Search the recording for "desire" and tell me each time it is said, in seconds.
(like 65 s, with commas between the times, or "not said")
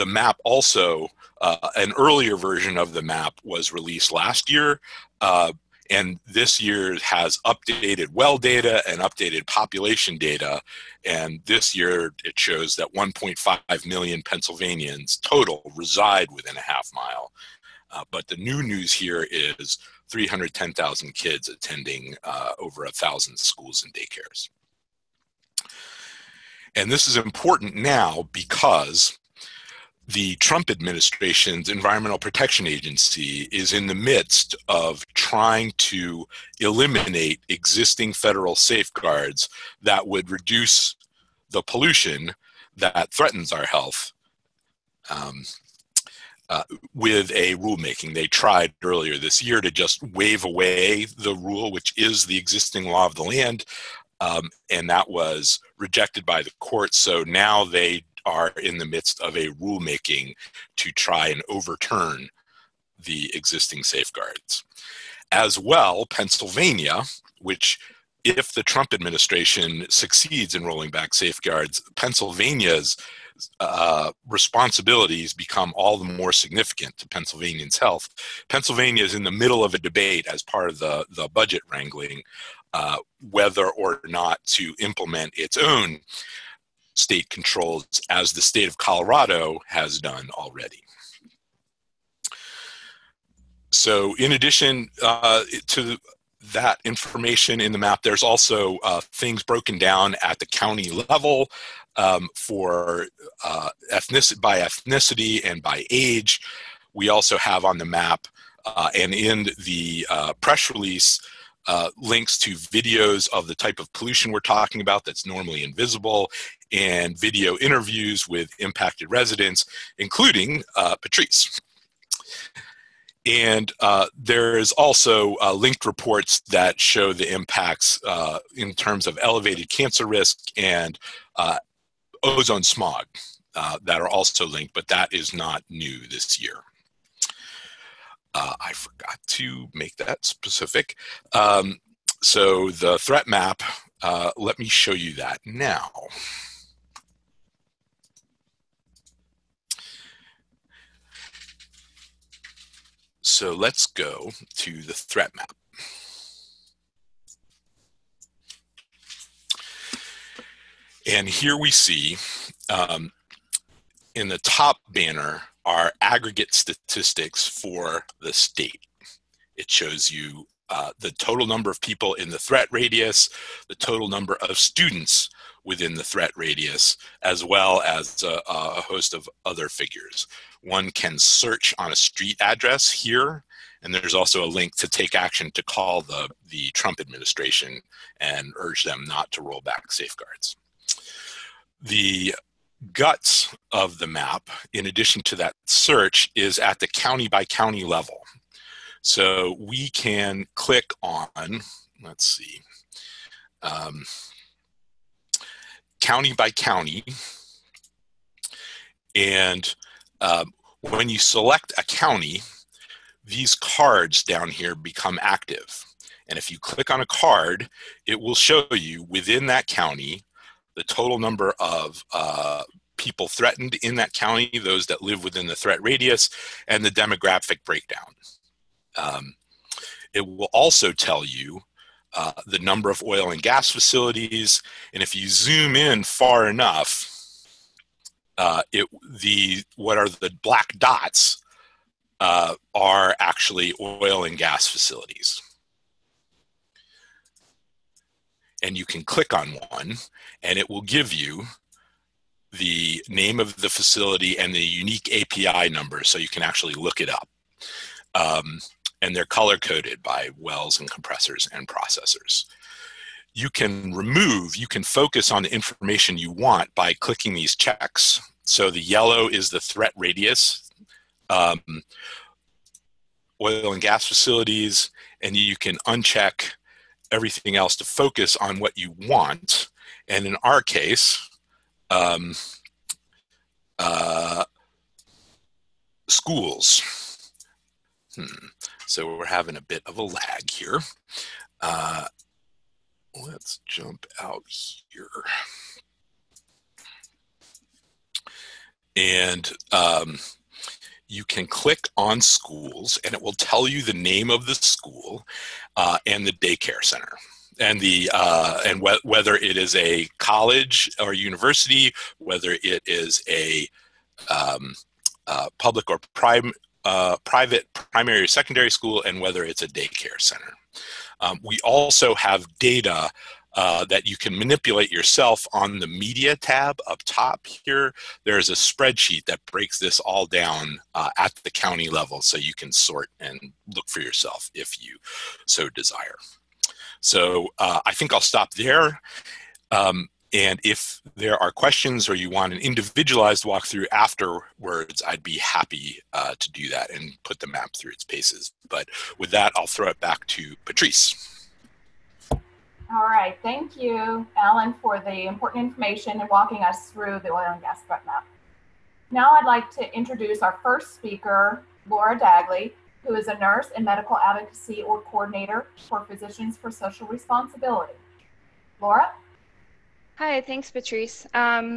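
335 s.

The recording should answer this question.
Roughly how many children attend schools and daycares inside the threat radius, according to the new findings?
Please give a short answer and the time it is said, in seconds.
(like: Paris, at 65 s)
310,000, at 20 s.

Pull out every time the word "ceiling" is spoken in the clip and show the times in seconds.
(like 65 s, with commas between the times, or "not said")
not said.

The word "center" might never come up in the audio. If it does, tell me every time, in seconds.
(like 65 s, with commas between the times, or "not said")
306 s, 320 s.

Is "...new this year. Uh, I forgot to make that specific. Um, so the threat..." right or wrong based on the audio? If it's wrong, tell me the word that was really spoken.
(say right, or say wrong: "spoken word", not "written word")
right.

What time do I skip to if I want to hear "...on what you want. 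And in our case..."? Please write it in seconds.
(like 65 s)
278 s.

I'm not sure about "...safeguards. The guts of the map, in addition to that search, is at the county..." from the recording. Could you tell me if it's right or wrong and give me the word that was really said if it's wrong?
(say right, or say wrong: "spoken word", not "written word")
right.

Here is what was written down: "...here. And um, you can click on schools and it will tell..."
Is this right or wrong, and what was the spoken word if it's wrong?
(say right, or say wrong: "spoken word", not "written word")
right.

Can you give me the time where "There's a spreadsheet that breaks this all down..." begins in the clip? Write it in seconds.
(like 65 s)
328 s.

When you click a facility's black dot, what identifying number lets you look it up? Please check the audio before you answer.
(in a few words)
API number.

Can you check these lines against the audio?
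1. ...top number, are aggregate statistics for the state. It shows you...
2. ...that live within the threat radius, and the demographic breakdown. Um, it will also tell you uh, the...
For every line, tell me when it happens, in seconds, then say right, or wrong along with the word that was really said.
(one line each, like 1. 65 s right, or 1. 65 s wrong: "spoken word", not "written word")
1. 164 s wrong: "banner", not "number"
2. 224 s right.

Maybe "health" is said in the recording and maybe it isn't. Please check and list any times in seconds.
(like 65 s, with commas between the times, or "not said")
43 s, 77 s.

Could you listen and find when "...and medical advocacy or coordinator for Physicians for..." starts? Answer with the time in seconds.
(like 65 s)
363 s.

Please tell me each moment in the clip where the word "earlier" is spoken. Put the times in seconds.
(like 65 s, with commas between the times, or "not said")
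1 s, 48 s.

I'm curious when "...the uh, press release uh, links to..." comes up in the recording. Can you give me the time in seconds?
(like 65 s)
109 s.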